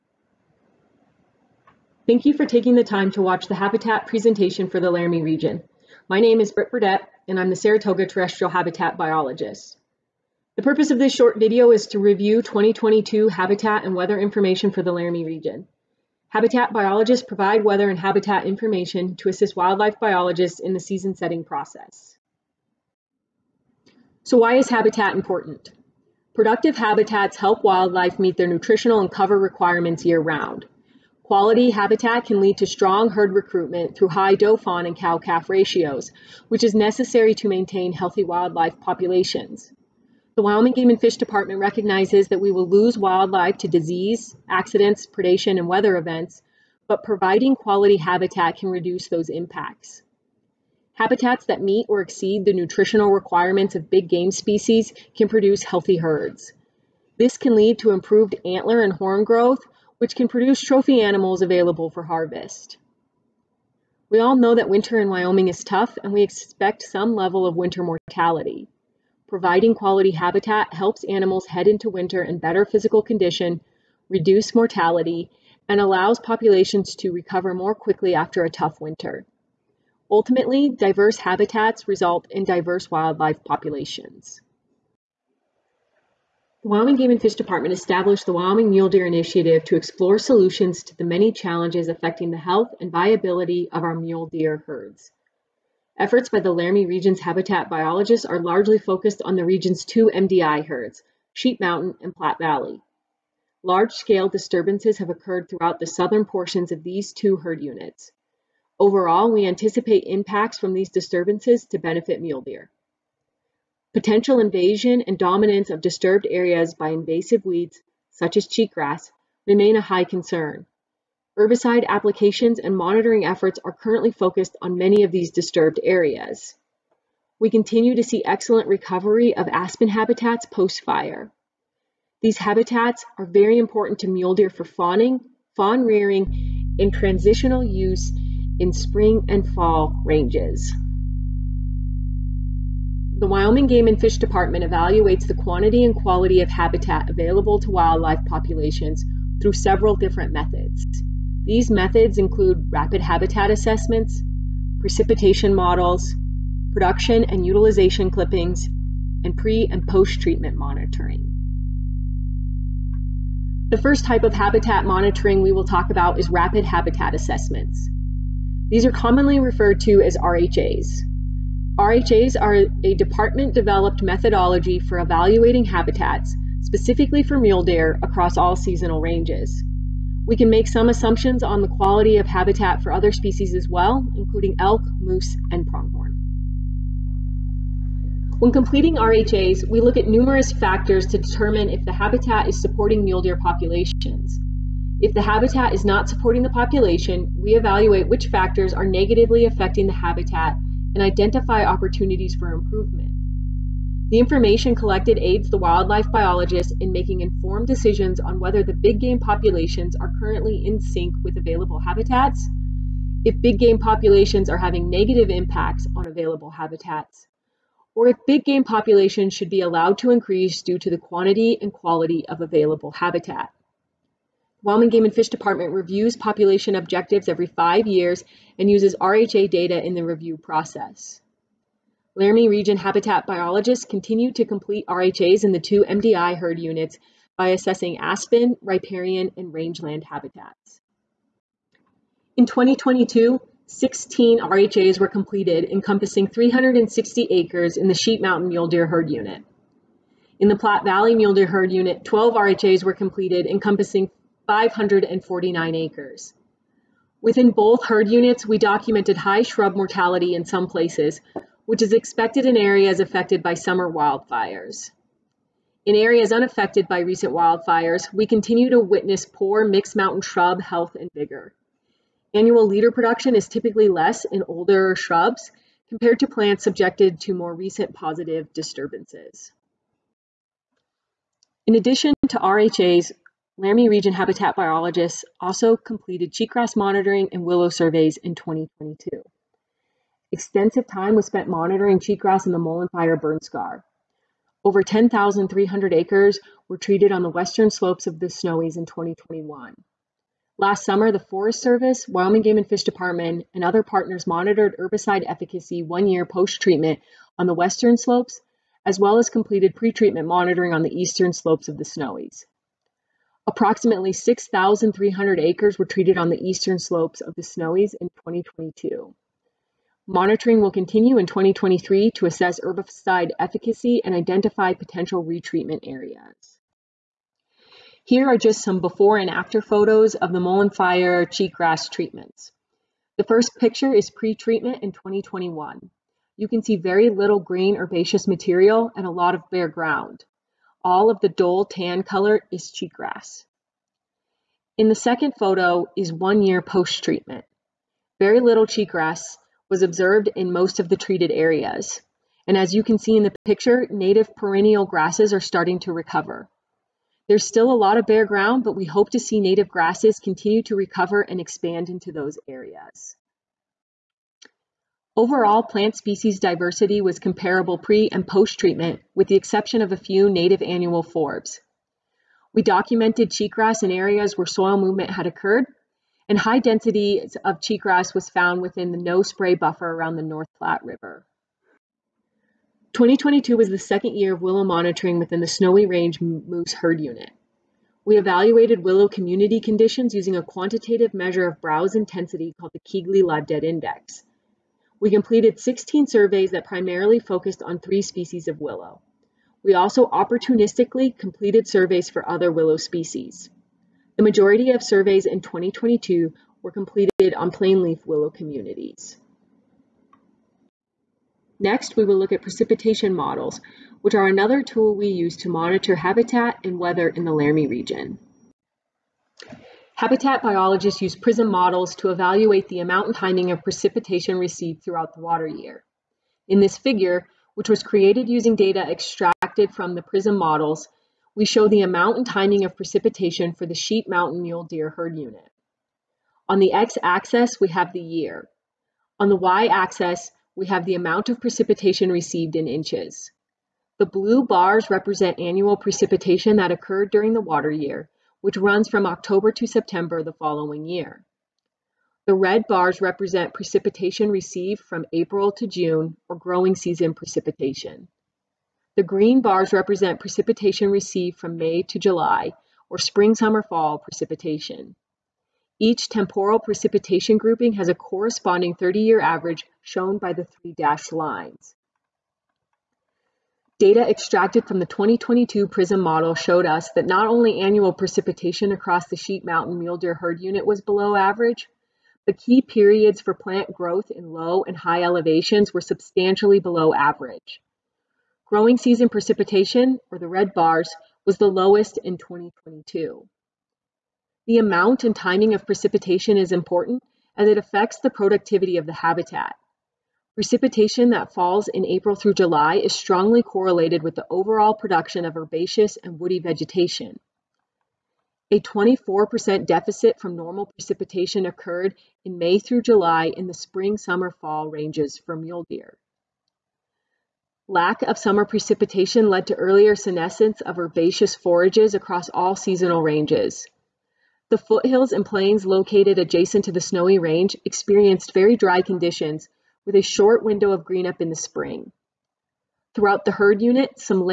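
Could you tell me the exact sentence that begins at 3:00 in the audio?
We can make some assumptions on the quality of habitat for other species as well, including elk, moose, and pronghorn.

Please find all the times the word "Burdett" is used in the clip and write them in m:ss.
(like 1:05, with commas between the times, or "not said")
0:06.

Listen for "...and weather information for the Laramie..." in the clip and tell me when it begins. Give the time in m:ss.
0:13.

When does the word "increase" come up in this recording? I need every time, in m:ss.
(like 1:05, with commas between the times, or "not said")
3:40.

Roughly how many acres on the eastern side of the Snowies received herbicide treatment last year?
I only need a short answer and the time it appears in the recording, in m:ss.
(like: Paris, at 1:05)
6,300 acres, at 5:14.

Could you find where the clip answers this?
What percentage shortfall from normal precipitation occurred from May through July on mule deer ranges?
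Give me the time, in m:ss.
8:28.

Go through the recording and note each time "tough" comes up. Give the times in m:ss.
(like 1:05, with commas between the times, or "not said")
1:05, 1:18.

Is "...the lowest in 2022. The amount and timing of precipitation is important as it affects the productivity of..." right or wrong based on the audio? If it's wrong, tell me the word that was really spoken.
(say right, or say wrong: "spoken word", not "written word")
right.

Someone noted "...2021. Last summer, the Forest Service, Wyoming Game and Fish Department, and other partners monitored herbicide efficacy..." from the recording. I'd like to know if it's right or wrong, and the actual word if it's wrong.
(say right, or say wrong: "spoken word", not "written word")
right.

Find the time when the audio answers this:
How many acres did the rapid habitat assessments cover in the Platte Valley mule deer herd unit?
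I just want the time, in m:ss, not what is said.
4:14.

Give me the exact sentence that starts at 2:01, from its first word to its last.
Herbicide applications and monitoring efforts are currently focused on many of these disturbed areas.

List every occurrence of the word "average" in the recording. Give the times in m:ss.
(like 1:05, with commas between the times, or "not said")
7:49, 8:01, 8:06.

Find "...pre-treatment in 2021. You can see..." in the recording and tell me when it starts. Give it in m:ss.
5:34.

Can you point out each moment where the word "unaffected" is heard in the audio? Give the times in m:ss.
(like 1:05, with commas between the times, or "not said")
4:26.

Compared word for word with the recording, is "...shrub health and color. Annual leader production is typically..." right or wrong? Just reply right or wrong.
wrong.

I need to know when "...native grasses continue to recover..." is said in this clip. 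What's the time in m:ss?
5:59.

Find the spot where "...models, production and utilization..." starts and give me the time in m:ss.
2:35.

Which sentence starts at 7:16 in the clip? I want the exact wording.
On the x-axis, we have the year.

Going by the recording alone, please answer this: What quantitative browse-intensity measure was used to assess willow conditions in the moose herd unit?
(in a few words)
Keigley Live Dead Index.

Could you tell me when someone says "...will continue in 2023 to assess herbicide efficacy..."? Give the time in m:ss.
5:20.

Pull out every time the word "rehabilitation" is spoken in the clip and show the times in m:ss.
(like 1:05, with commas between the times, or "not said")
not said.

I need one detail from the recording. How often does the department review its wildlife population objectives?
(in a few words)
every 5 years.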